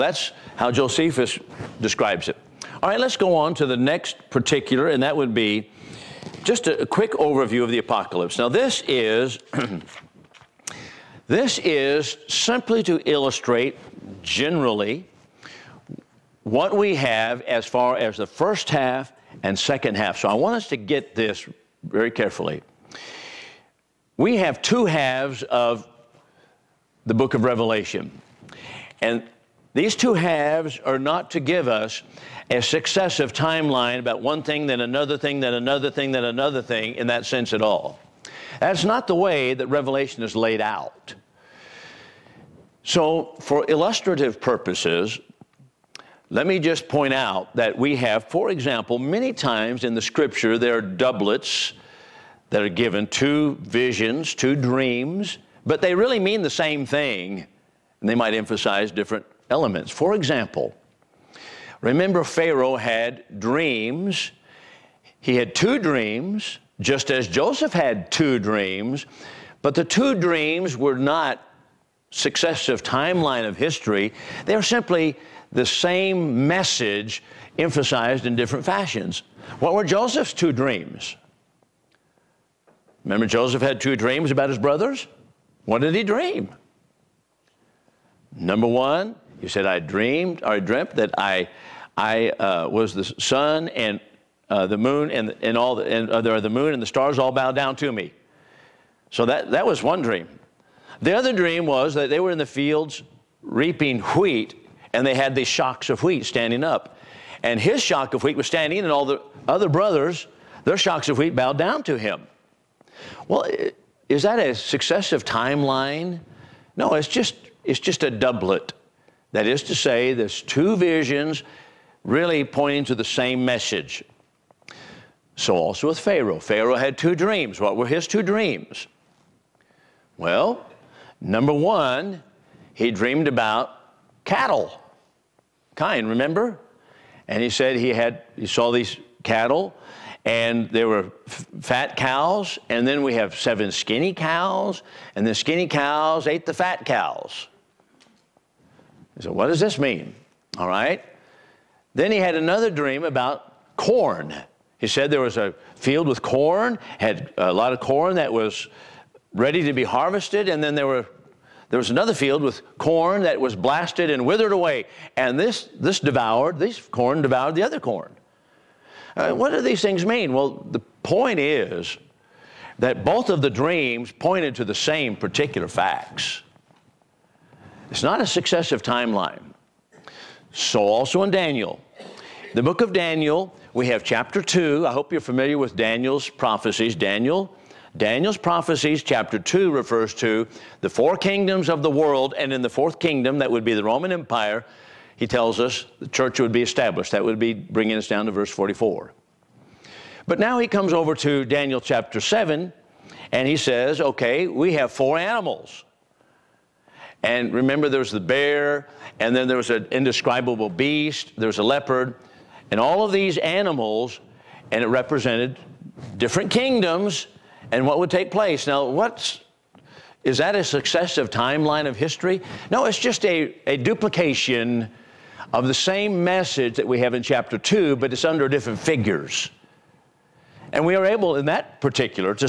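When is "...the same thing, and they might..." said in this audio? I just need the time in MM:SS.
00:56.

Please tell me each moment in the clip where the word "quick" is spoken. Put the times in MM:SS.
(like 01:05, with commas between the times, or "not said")
00:06.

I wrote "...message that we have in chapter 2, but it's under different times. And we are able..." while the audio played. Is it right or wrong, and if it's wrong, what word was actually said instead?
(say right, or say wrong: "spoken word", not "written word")
wrong: "figures", not "times".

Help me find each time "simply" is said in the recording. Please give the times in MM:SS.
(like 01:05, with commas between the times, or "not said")
00:12, 01:14.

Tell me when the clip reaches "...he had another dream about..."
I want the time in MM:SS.
02:32.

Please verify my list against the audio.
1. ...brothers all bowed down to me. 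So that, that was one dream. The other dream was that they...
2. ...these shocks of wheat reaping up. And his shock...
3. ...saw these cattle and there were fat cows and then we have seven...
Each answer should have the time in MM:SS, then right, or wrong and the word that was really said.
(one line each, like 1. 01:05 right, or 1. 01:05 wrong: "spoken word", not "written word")
1. 01:36 wrong: "stars", not "brothers"
2. 01:45 wrong: "standing", not "reaping"
3. 02:18 right.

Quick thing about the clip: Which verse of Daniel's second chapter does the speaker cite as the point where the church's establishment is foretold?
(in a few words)
Verse 44.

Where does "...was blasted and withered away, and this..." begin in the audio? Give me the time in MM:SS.
02:43.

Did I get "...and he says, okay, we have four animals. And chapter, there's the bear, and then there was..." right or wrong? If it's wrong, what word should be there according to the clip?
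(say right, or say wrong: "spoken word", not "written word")
wrong: "remember", not "chapter".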